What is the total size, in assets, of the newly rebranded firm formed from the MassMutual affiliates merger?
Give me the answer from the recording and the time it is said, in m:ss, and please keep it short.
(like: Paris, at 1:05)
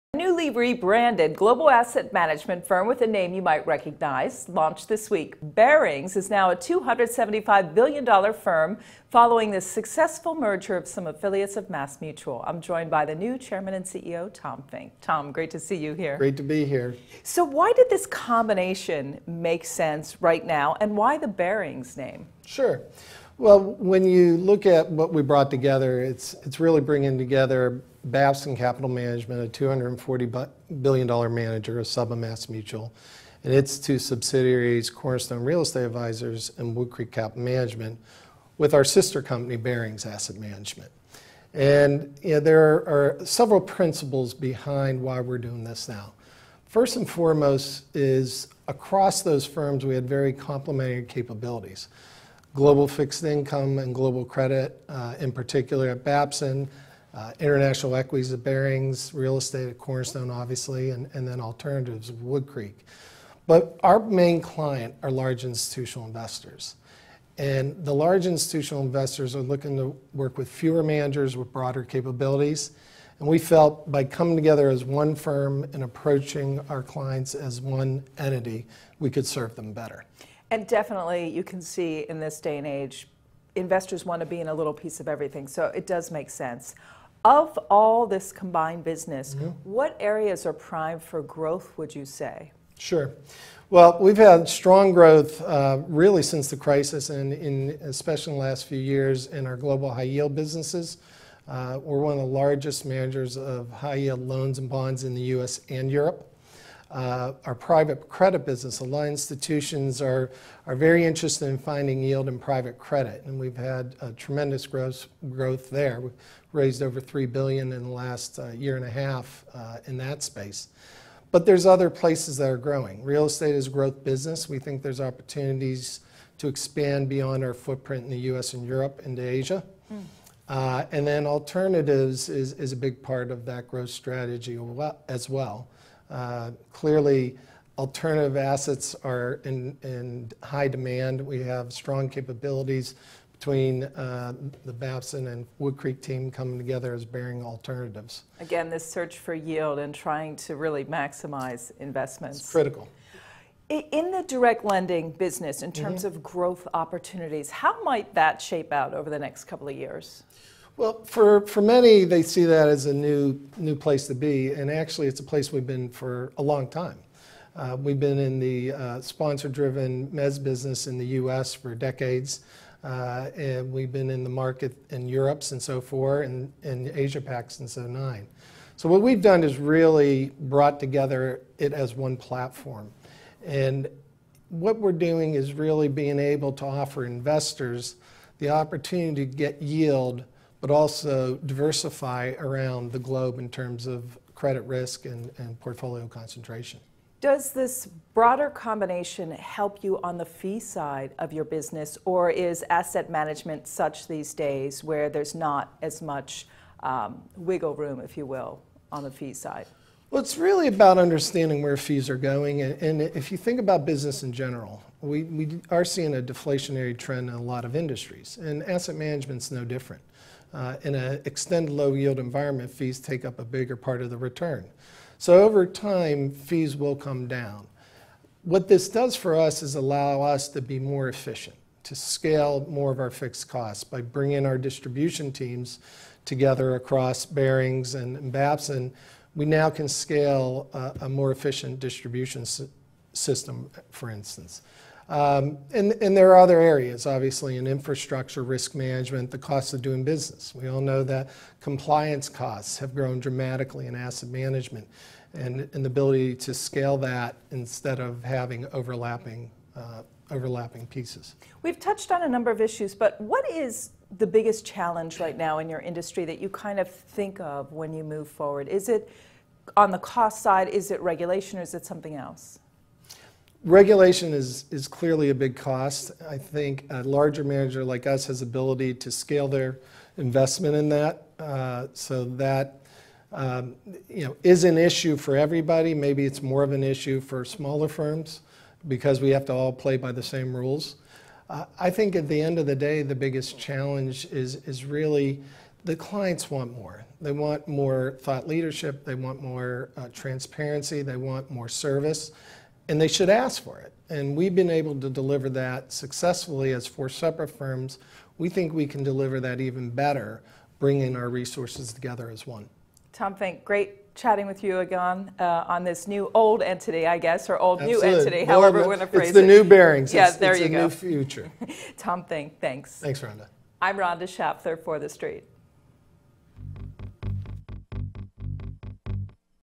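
$275 billion, at 0:06.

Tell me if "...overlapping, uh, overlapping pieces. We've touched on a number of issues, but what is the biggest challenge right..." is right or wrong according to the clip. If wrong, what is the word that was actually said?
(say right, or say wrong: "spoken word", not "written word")
right.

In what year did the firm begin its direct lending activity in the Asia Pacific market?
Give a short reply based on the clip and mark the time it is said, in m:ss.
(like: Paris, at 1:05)
2009, at 2:57.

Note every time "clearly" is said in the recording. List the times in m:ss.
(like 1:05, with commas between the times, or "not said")
2:16, 4:34.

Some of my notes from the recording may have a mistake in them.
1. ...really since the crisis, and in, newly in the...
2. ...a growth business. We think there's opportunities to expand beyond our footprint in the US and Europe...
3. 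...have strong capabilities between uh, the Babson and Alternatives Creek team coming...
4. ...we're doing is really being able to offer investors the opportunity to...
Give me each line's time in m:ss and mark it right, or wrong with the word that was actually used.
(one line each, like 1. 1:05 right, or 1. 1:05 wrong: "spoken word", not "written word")
1. 1:35 wrong: "especially", not "newly"
2. 2:03 right
3. 2:21 wrong: "Wood", not "Alternatives"
4. 3:04 right.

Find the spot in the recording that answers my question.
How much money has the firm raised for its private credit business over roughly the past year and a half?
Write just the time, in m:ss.
1:56.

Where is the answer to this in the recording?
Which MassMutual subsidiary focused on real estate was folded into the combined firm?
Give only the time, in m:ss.
0:34.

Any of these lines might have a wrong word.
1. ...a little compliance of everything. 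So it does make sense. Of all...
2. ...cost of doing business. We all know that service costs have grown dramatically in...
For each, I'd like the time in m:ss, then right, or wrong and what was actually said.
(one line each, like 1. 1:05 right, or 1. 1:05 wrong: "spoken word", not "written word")
1. 1:24 wrong: "piece", not "compliance"
2. 4:09 wrong: "compliance", not "service".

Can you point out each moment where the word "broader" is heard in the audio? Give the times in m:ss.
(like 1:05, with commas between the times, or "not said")
1:11, 3:18.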